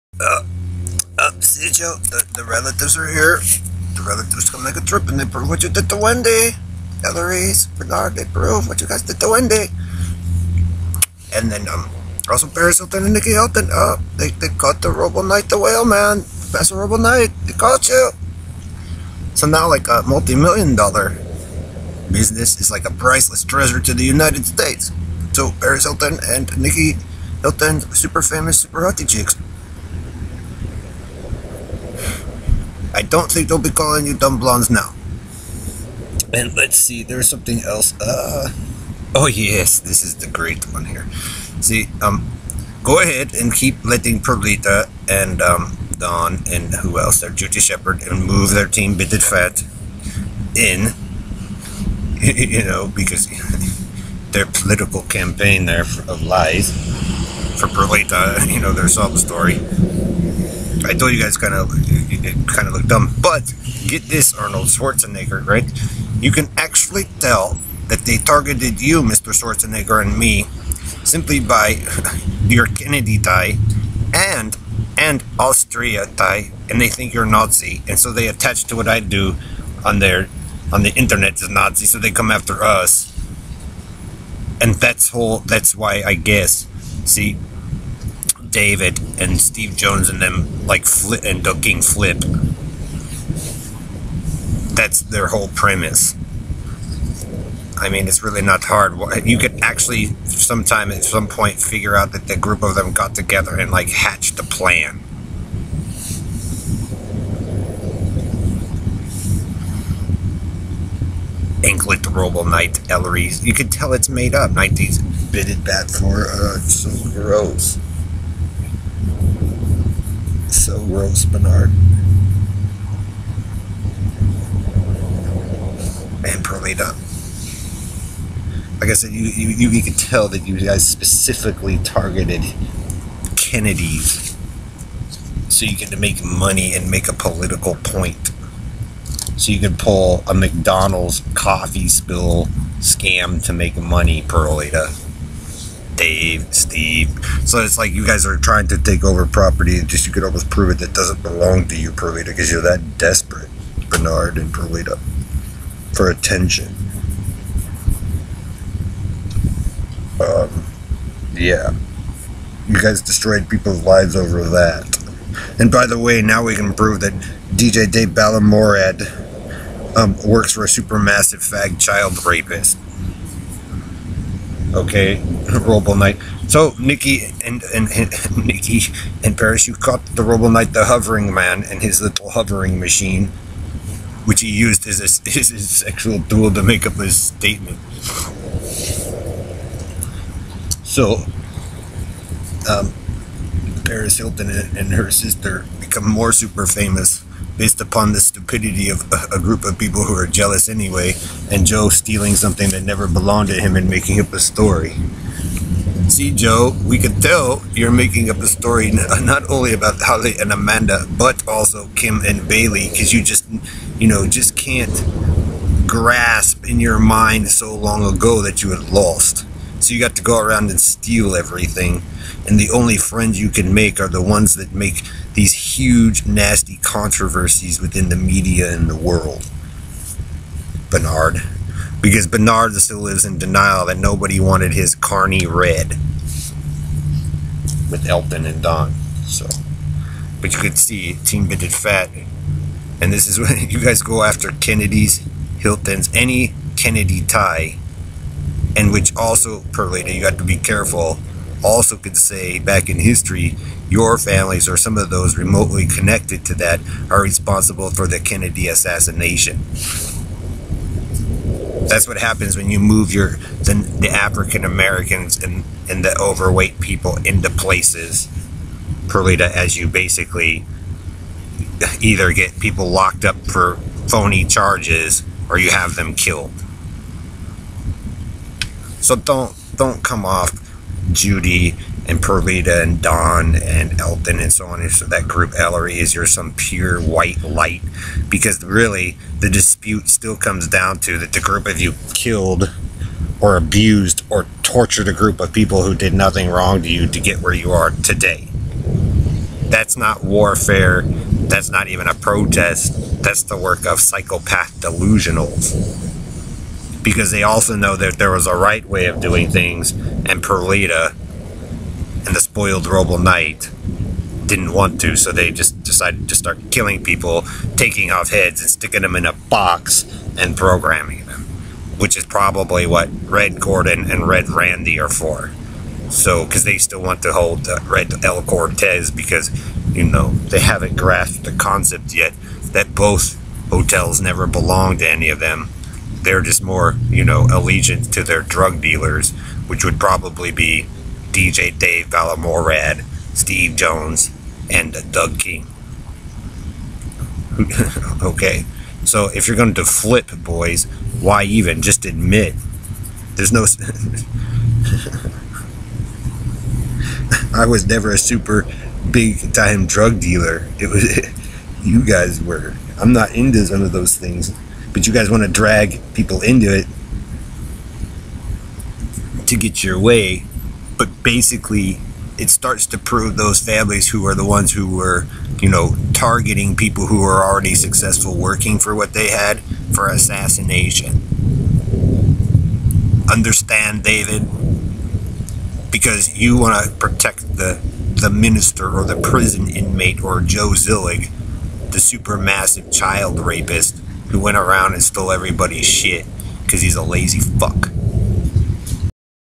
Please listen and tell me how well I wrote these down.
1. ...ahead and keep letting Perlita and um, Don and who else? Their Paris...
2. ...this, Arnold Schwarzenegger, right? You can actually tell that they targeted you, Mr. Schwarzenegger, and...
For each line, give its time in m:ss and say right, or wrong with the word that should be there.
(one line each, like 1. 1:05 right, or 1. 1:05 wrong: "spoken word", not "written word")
1. 0:43 wrong: "Judy", not "Paris"
2. 1:04 right.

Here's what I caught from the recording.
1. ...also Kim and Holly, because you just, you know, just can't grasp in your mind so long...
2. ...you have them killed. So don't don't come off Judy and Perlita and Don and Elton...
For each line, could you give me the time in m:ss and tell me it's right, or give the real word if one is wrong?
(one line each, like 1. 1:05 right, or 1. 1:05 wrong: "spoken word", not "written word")
1. 3:31 wrong: "Bailey", not "Holly"
2. 4:35 right.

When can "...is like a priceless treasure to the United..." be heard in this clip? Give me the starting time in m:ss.
0:22.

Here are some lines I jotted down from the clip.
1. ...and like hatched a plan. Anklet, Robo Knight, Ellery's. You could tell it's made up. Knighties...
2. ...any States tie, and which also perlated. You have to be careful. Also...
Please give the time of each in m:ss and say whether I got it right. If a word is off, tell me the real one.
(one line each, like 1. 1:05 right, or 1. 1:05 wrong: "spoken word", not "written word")
1. 1:43 right
2. 4:06 wrong: "Kennedy", not "States".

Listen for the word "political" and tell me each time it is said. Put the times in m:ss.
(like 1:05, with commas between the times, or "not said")
0:54, 2:17.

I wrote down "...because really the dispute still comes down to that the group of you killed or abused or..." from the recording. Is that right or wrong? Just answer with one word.
right.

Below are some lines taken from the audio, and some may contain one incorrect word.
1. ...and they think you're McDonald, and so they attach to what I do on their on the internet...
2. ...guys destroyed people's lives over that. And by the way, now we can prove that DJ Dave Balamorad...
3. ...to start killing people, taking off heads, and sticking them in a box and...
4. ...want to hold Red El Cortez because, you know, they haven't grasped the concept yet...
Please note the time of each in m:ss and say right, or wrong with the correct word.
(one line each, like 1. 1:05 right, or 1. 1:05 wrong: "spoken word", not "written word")
1. 1:16 wrong: "Nazi", not "McDonald"
2. 2:42 right
3. 5:16 right
4. 5:27 right.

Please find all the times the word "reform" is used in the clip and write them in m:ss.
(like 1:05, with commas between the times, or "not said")
not said.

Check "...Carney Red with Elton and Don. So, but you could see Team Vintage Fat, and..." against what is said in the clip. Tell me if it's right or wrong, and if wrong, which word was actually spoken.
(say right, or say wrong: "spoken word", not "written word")
right.